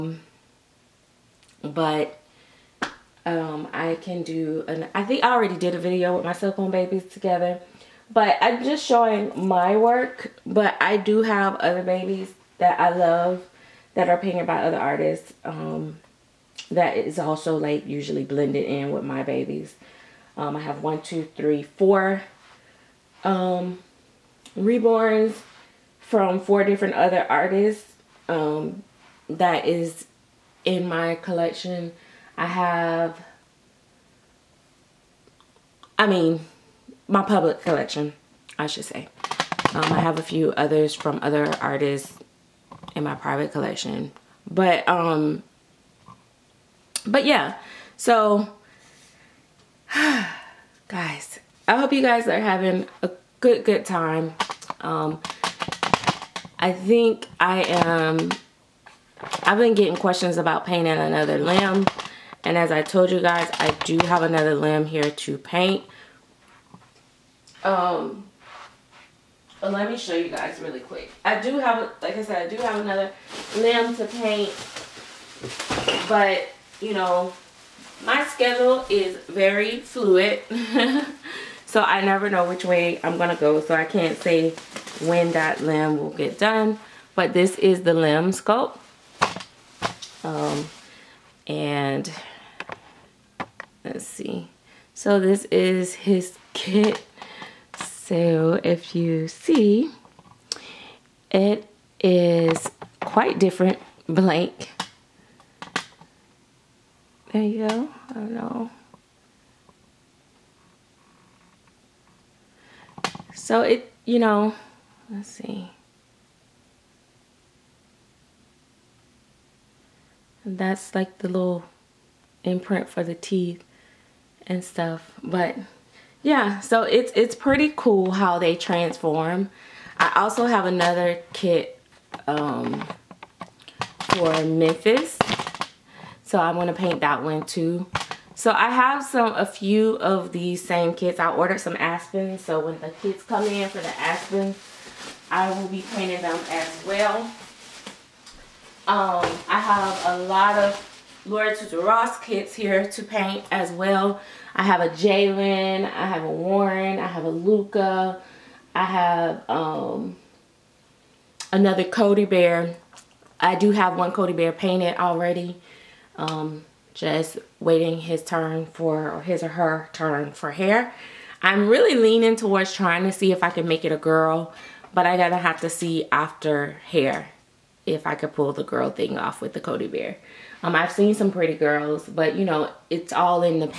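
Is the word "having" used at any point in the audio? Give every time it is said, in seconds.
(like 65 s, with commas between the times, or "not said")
52 s.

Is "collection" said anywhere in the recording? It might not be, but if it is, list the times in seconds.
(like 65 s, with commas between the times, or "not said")
31 s, 37 s, 43 s.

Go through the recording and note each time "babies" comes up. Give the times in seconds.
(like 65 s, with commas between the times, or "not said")
6 s, 11 s, 19 s.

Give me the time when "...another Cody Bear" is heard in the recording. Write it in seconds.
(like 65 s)
161 s.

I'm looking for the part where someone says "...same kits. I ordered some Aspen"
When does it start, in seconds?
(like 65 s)
140 s.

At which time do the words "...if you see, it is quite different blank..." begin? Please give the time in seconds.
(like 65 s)
98 s.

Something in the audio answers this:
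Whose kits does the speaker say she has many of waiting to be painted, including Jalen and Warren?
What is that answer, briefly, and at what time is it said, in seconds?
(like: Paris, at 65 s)
Laura Tuzio Ross, at 151 s.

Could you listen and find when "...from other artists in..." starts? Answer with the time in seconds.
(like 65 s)
40 s.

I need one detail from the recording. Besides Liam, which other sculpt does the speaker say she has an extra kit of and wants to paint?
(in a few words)
Memphis.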